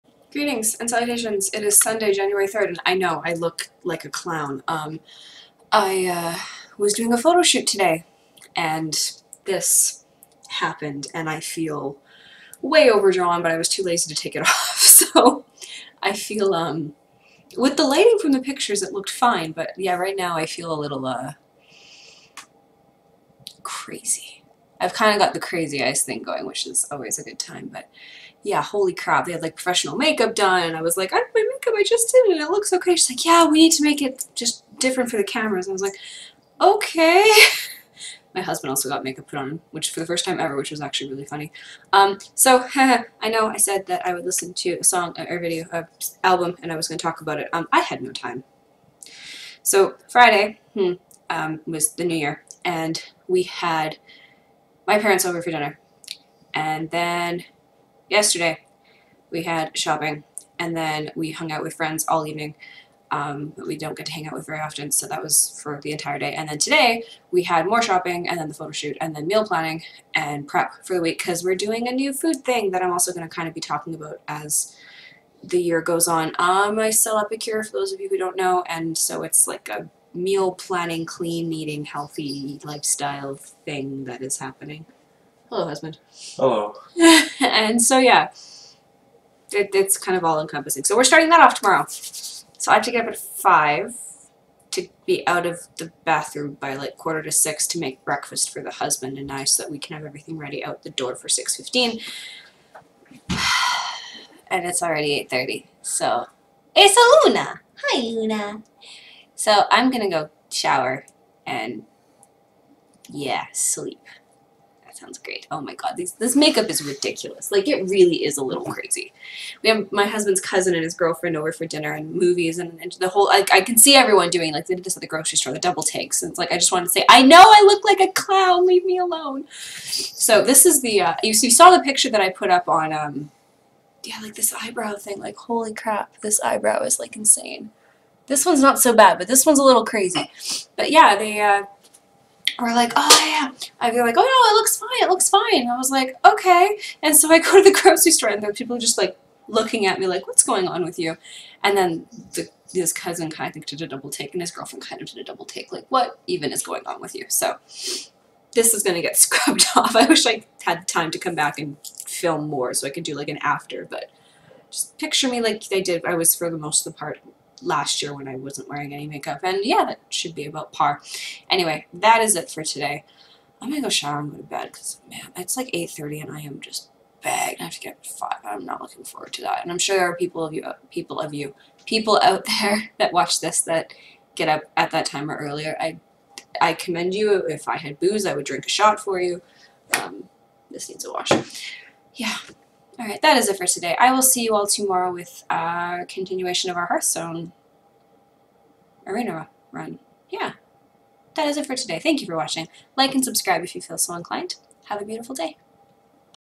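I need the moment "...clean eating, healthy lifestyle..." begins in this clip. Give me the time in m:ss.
1:21.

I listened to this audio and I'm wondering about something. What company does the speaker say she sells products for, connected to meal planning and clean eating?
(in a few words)
Epicure.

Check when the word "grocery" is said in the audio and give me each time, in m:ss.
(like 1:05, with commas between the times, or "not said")
2:05, 2:27.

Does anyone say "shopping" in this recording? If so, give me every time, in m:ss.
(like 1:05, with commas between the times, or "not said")
0:59, 1:07.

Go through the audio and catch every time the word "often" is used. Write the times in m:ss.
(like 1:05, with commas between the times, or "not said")
1:04.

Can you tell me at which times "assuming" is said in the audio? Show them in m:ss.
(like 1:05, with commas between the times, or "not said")
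not said.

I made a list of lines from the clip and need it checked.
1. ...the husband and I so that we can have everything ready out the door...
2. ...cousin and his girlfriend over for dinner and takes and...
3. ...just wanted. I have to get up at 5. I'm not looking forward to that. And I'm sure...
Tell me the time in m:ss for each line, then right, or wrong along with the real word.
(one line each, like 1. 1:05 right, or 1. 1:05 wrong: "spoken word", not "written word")
1. 1:38 right
2. 2:00 wrong: "movies", not "takes"
3. 2:56 wrong: "bagged", not "wanted".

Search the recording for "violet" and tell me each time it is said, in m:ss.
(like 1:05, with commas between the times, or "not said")
not said.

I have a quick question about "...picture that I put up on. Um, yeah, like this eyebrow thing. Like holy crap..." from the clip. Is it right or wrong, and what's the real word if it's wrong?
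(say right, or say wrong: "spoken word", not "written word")
right.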